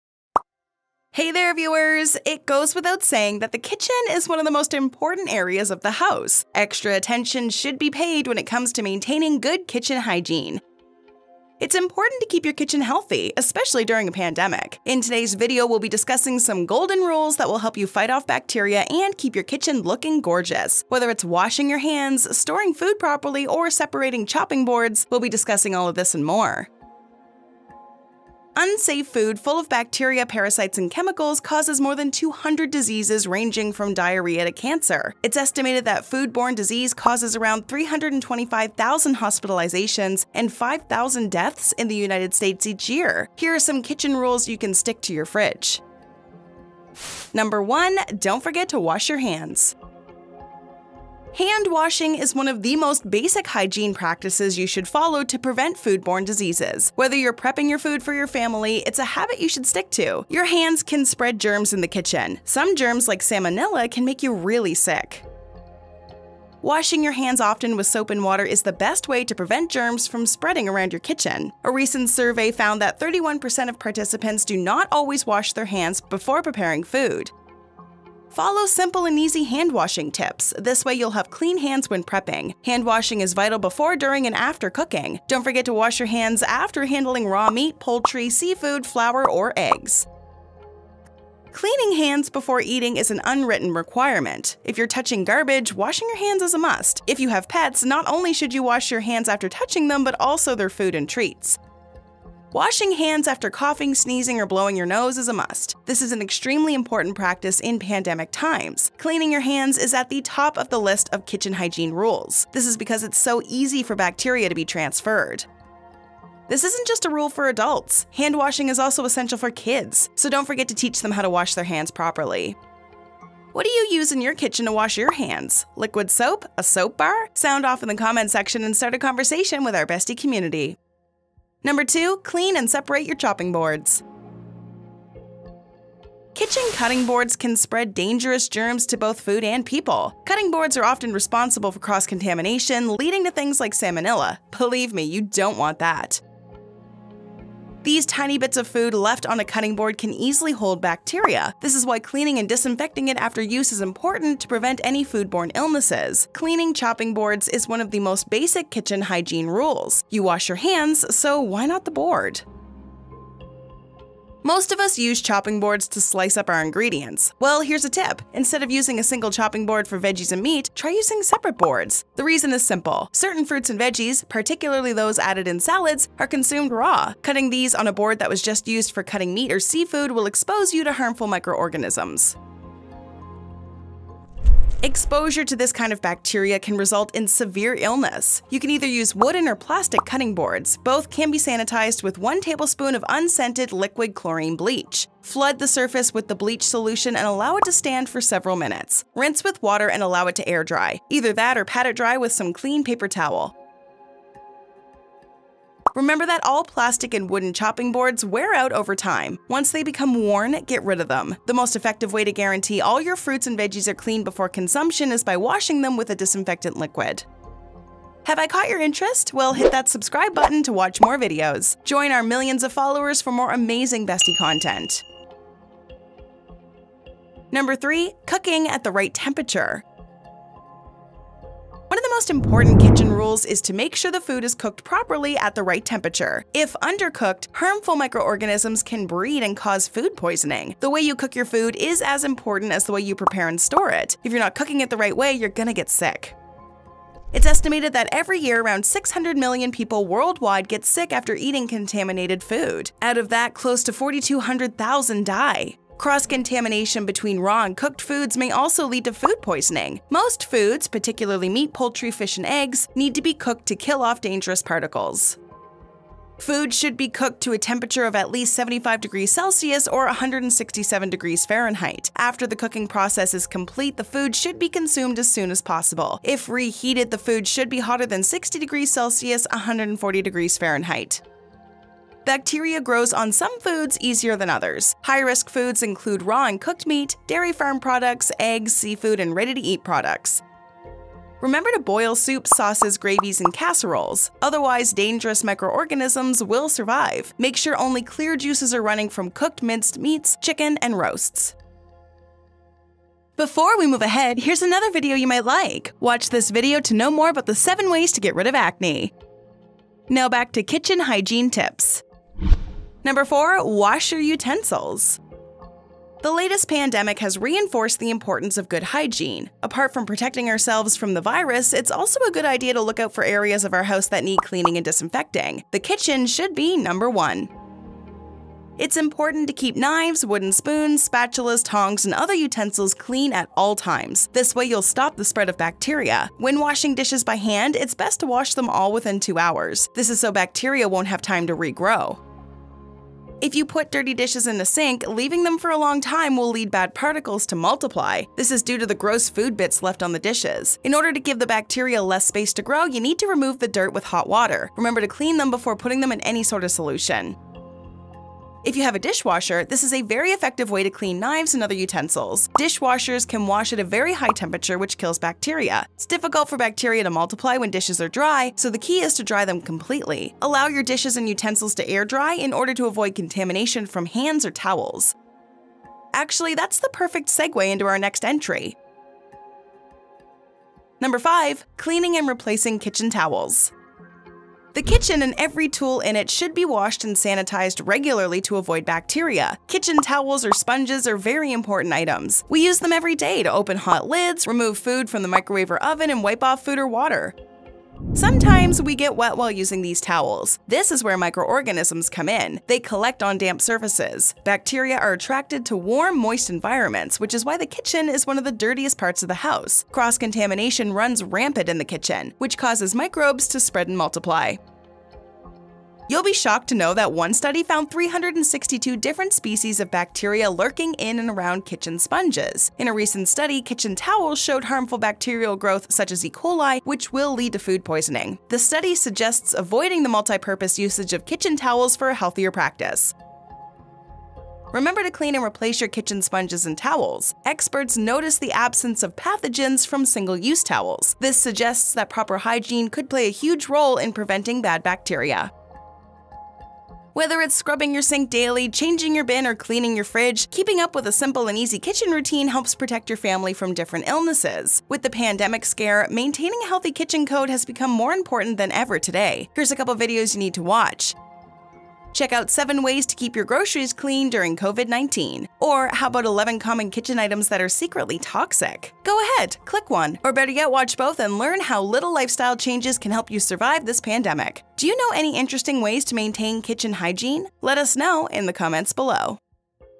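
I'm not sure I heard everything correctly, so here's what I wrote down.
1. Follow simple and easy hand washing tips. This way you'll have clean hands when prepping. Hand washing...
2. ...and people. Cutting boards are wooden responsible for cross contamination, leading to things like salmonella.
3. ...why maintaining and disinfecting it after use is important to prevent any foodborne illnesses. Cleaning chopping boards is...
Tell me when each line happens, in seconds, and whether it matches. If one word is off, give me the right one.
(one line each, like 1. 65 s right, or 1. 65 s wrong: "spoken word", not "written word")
1. 78 s right
2. 139 s wrong: "often", not "wooden"
3. 151 s wrong: "cleaning", not "maintaining".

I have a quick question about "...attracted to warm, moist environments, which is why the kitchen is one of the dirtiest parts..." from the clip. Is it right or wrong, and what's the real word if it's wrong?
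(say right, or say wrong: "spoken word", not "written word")
right.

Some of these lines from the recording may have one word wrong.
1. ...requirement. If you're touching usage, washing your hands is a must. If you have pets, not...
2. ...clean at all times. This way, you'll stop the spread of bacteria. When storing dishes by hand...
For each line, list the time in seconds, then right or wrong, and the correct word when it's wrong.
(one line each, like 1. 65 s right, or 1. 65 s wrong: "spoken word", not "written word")
1. 93 s wrong: "garbage", not "usage"
2. 332 s wrong: "washing", not "storing".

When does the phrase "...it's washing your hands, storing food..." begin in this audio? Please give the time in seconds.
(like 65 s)
21 s.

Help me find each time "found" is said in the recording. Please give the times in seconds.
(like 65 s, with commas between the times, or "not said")
72 s, 417 s.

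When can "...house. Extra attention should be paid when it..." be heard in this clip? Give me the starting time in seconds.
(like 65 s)
5 s.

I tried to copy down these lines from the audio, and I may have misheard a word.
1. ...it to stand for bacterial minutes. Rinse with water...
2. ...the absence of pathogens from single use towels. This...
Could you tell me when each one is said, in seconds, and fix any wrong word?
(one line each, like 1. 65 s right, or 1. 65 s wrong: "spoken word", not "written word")
1. 197 s wrong: "several", not "bacterial"
2. 438 s right.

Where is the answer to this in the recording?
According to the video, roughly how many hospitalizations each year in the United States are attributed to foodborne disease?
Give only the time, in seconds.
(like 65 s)
37 s.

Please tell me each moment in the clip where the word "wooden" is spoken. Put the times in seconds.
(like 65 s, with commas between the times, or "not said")
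189 s, 207 s, 330 s.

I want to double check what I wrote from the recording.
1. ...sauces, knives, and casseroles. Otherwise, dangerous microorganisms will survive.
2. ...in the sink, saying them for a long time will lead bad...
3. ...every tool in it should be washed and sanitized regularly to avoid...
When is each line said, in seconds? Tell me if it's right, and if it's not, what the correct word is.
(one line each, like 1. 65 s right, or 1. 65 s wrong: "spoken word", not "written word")
1. 292 s wrong: "gravies", not "knives"
2. 344 s wrong: "leaving", not "saying"
3. 385 s right.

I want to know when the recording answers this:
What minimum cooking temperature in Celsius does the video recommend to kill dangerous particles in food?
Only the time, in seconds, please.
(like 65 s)
268 s.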